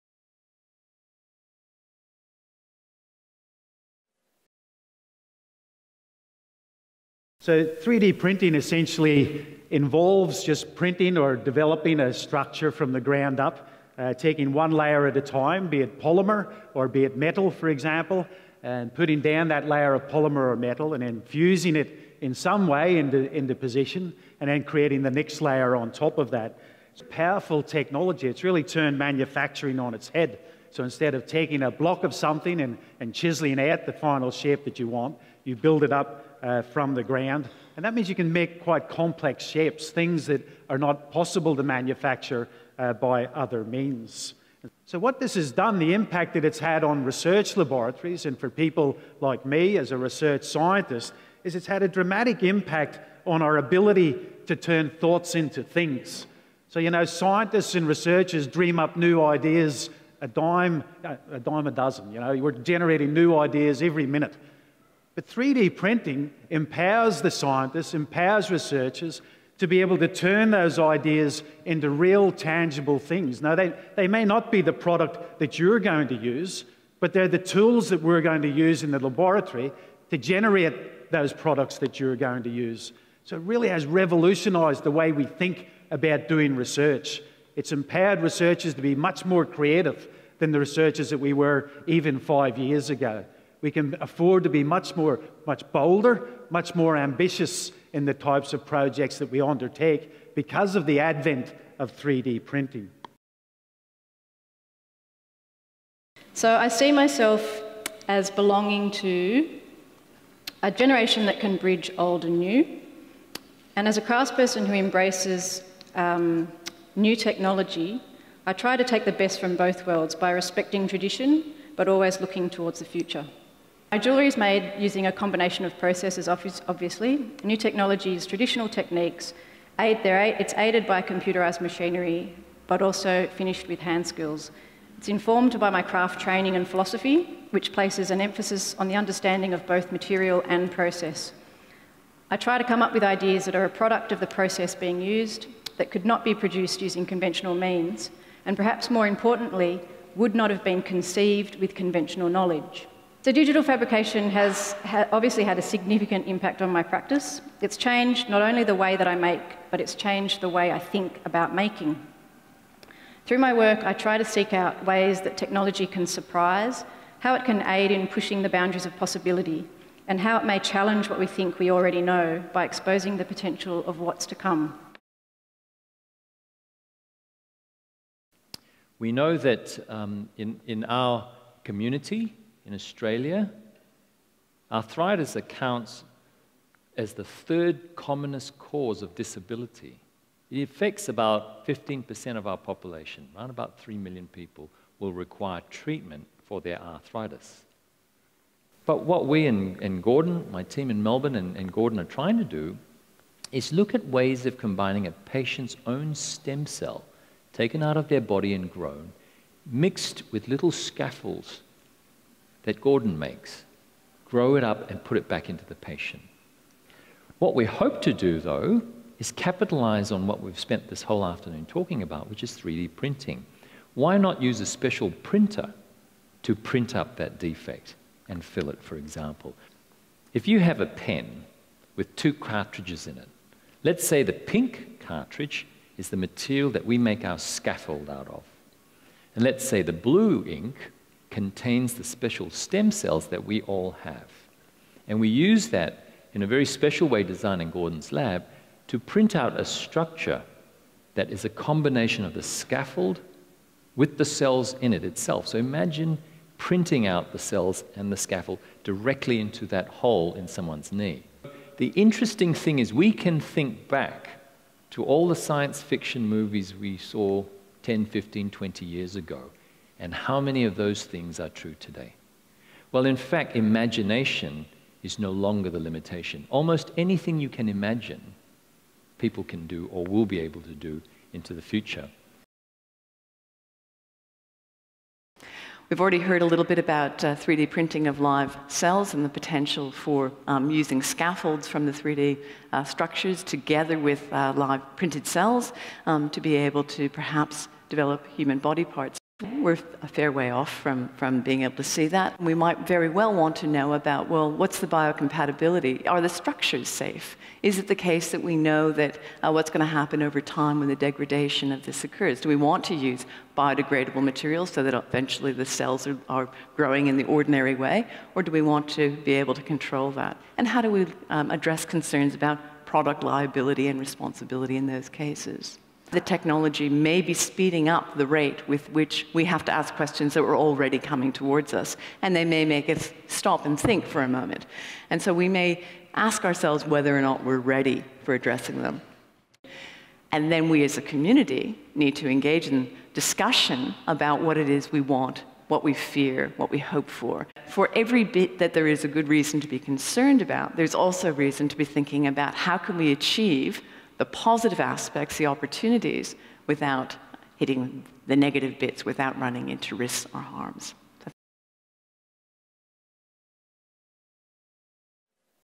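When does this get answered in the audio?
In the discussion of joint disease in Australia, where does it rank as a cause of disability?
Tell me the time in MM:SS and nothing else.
03:07.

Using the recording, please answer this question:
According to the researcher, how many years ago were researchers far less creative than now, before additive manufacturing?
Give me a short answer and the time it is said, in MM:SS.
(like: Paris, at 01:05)
5, at 01:32.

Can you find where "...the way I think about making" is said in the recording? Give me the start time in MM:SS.
02:40.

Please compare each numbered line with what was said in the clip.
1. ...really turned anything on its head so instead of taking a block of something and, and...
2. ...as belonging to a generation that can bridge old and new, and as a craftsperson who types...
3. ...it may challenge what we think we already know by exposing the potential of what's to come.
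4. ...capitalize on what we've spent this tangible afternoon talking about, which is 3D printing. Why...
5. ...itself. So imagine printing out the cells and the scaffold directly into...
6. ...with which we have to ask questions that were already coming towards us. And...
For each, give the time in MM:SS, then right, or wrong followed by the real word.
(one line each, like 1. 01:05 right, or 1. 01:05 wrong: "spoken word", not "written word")
1. 00:28 wrong: "manufacturing", not "anything"
2. 01:48 wrong: "embraces", not "types"
3. 02:50 right
4. 03:39 wrong: "whole", not "tangible"
5. 04:15 right
6. 05:28 right.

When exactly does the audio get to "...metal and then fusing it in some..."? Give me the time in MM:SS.
00:20.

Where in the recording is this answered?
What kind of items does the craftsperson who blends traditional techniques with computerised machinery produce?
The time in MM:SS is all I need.
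02:03.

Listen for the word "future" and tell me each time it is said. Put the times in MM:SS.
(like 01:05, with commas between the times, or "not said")
02:02, 04:41.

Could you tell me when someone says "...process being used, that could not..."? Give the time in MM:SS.
02:24.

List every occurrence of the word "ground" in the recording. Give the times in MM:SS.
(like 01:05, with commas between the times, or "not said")
00:13, 00:37.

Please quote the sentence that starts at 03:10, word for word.
It affects about 15% of our population, around about 3 million people will require treatment for their arthritis.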